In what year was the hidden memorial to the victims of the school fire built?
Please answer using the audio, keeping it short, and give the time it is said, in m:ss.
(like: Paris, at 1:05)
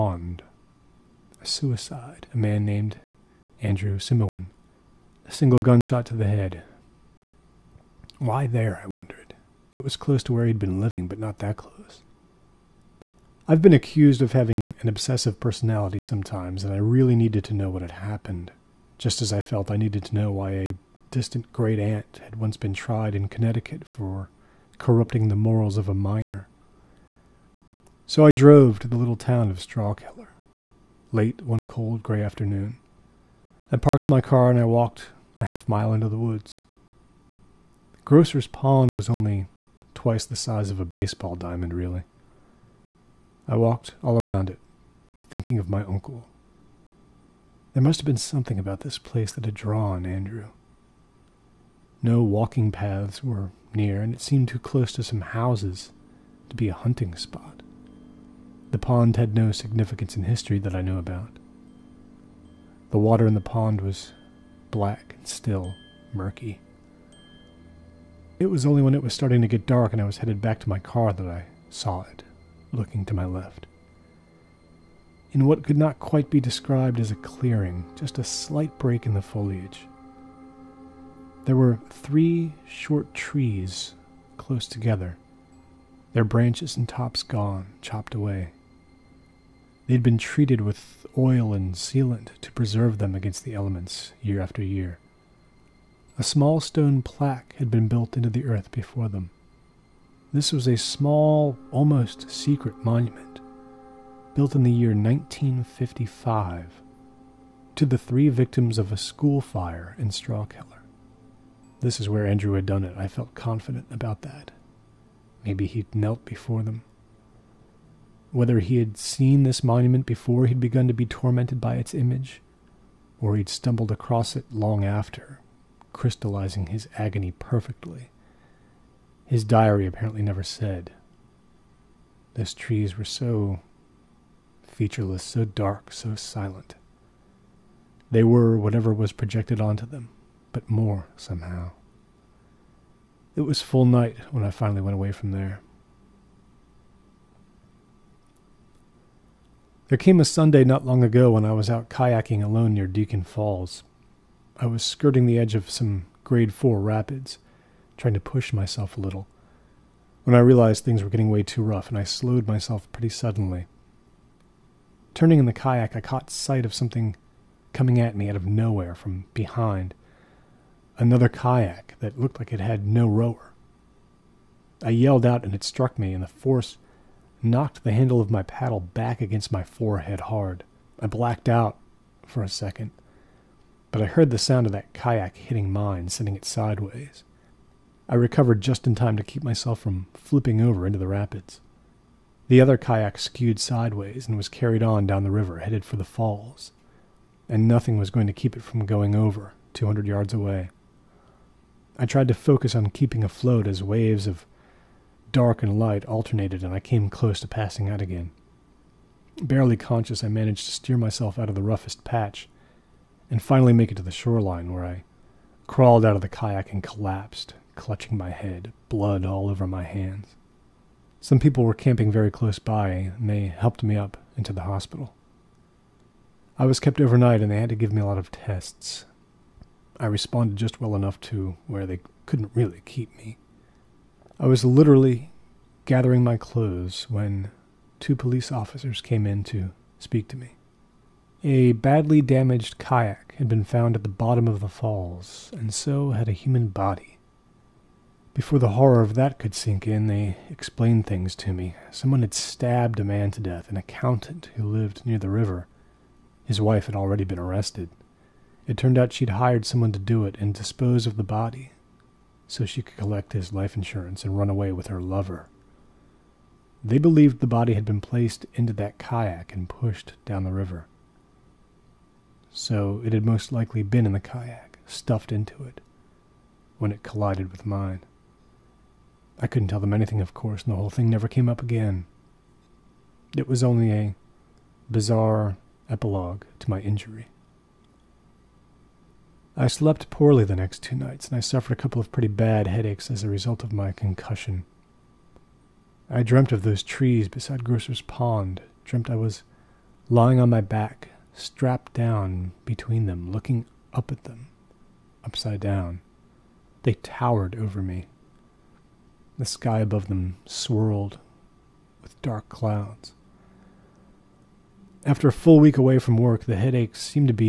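1955, at 1:44.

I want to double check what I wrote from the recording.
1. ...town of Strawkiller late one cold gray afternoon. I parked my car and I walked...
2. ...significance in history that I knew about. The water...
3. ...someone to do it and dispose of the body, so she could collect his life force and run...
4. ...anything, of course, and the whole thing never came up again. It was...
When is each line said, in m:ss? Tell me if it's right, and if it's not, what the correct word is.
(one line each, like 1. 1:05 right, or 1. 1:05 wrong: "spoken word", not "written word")
1. 0:29 right
2. 0:59 right
3. 4:19 wrong: "insurance", not "force"
4. 4:39 right.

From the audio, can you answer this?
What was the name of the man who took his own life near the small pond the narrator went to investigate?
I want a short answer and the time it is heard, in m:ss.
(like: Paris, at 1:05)
Andrew Simoin, at 0:03.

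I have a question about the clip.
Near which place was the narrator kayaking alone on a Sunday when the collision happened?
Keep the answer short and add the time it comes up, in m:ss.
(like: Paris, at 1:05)
Deacon Falls, at 2:32.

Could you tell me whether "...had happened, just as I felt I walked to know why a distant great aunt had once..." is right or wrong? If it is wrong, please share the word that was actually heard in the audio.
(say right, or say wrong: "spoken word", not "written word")
wrong: "needed", not "walked".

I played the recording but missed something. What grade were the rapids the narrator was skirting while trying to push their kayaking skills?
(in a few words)
Grade 4.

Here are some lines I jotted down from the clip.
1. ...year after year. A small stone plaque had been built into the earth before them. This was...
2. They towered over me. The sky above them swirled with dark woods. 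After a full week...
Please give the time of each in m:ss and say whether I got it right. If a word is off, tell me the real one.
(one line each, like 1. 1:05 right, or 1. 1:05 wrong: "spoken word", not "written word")
1. 1:34 right
2. 5:06 wrong: "clouds", not "woods".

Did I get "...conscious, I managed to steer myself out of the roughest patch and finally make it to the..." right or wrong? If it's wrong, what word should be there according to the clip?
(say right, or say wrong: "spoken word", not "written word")
right.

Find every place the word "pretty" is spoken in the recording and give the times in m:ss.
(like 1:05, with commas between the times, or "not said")
2:42, 4:52.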